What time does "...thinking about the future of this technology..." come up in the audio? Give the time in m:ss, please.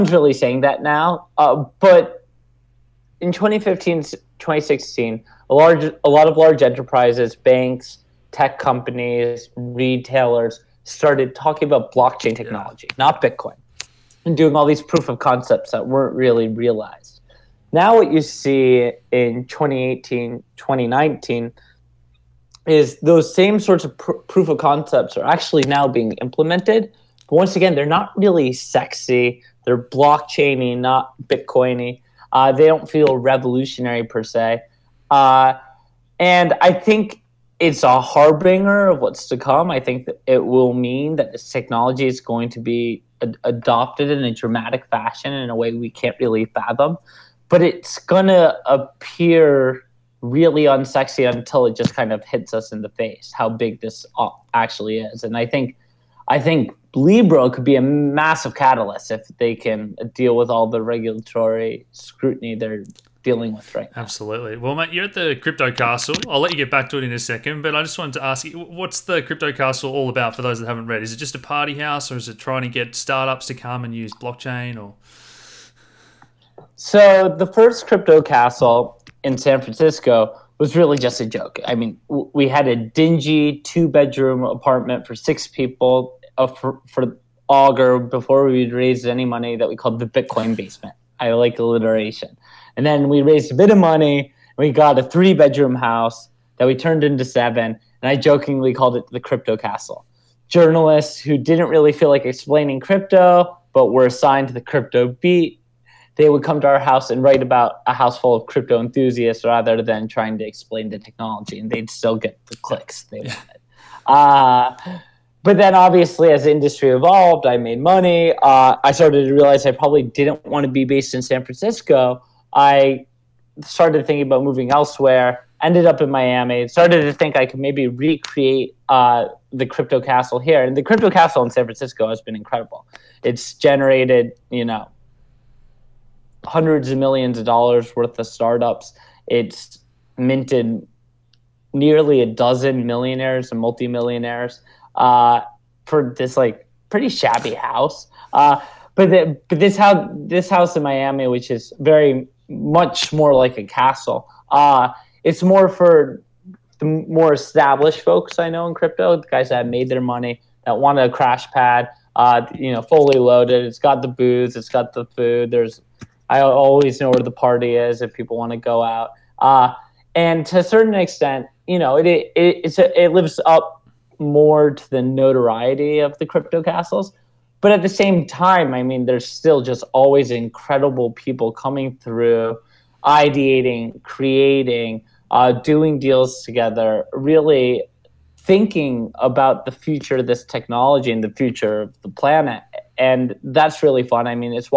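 3:08.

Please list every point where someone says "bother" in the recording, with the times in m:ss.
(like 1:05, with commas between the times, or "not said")
not said.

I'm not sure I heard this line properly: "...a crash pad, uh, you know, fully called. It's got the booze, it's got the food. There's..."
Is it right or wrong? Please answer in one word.
wrong.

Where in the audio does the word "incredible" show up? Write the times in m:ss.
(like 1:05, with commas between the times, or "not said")
2:12, 3:00.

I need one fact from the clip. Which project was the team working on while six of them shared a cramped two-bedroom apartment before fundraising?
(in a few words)
Augur.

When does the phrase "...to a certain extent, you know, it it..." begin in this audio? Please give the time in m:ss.
2:50.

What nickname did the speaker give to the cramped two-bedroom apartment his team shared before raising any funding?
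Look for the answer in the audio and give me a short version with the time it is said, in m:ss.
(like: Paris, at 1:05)
Bitcoin basement, at 1:30.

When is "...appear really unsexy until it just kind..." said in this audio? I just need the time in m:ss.
0:48.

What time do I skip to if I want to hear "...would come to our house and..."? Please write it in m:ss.
1:46.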